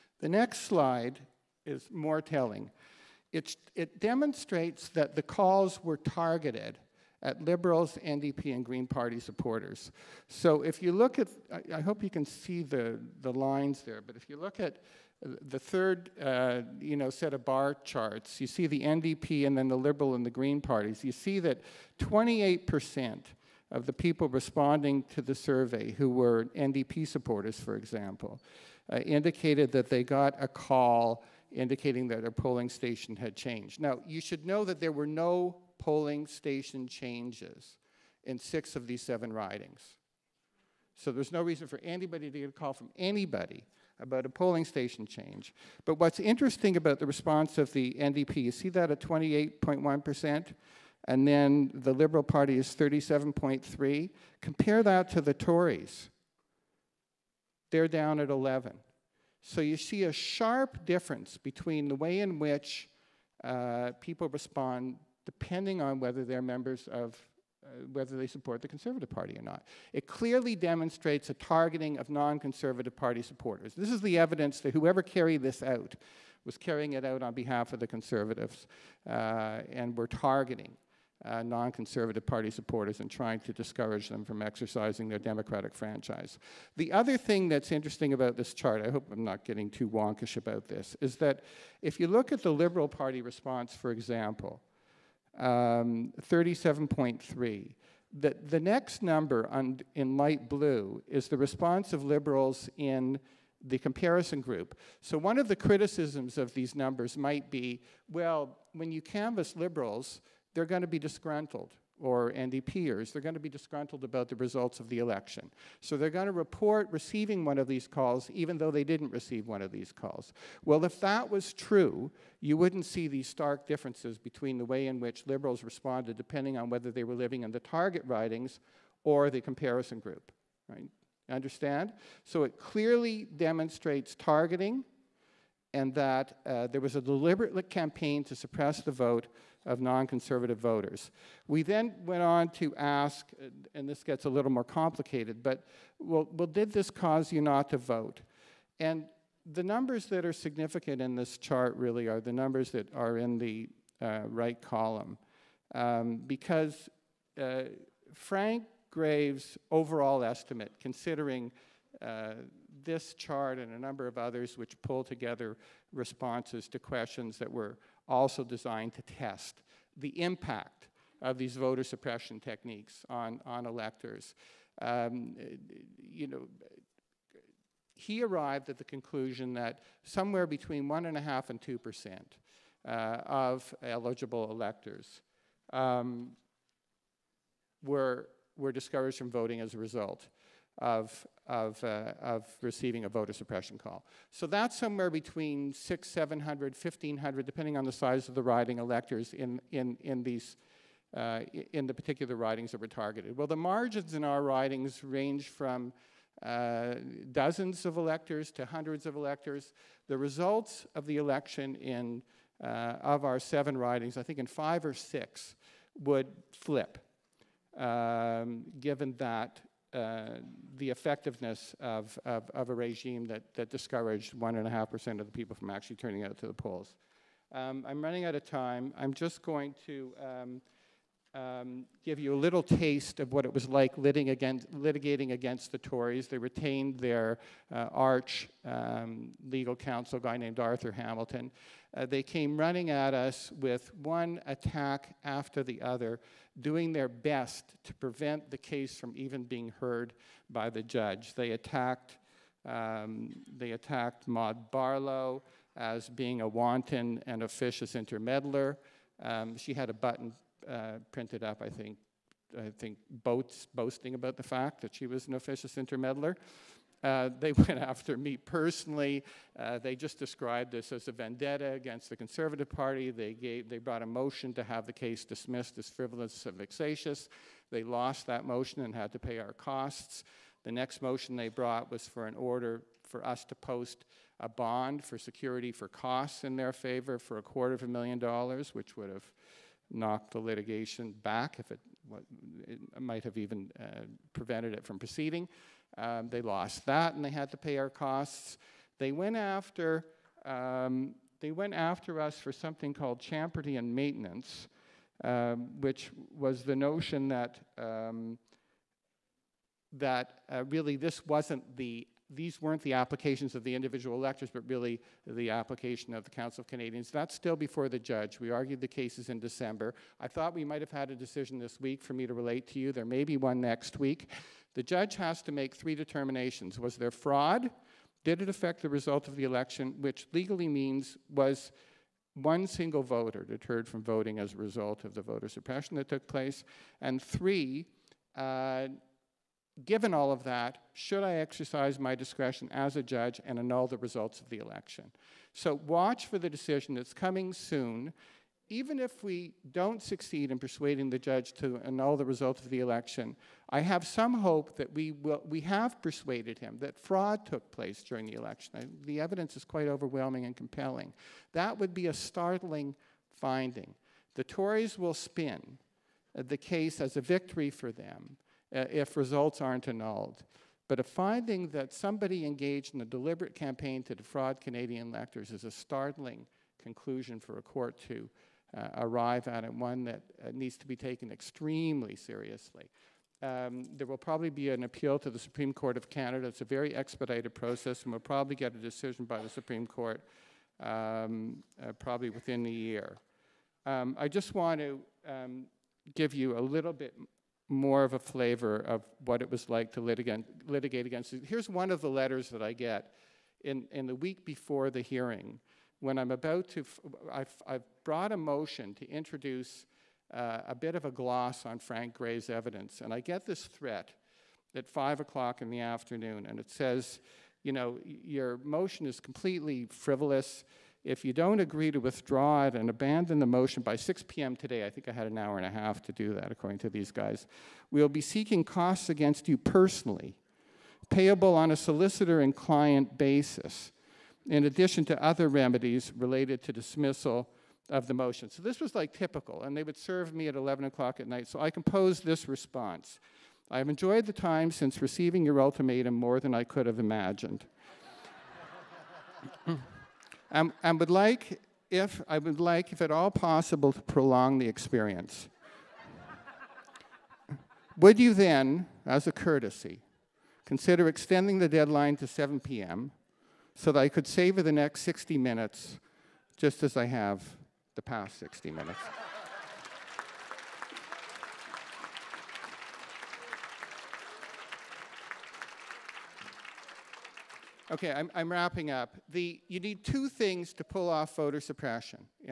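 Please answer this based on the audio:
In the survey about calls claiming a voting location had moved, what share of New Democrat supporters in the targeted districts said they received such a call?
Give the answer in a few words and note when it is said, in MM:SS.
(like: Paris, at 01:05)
28%, at 00:21.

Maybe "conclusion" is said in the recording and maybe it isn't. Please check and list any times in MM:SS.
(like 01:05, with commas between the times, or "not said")
02:58, 06:16.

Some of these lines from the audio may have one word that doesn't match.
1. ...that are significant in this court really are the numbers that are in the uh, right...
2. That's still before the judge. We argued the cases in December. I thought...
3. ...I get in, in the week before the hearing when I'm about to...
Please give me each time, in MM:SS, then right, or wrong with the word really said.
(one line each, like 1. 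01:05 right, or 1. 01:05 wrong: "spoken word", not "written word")
1. 02:30 wrong: "chart", not "court"
2. 05:17 right
3. 06:42 right.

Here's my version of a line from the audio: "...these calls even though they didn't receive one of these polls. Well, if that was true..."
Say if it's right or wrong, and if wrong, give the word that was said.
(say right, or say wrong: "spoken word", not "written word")
wrong: "calls", not "polls".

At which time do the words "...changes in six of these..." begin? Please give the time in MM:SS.
00:36.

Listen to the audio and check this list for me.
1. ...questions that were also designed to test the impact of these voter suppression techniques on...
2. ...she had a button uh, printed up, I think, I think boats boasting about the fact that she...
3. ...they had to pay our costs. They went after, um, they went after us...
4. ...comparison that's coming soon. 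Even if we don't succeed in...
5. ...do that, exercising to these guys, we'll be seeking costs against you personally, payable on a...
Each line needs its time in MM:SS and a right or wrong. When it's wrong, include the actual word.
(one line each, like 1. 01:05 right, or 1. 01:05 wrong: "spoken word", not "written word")
1. 02:46 right
2. 04:19 right
3. 04:57 right
4. 05:46 wrong: "decision", not "comparison"
5. 07:06 wrong: "according", not "exercising".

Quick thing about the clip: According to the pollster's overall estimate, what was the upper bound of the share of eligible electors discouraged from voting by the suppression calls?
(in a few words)
2%.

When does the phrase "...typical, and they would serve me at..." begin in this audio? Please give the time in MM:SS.
07:19.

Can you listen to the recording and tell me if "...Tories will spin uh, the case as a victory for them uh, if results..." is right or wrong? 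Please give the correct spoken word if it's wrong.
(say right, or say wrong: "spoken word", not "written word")
right.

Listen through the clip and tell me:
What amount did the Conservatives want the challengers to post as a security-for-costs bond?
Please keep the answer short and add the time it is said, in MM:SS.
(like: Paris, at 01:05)
$250,000, at 04:47.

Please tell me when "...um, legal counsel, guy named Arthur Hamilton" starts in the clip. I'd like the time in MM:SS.
03:58.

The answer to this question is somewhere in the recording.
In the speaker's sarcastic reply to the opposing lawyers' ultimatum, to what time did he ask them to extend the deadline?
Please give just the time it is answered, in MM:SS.
07:42.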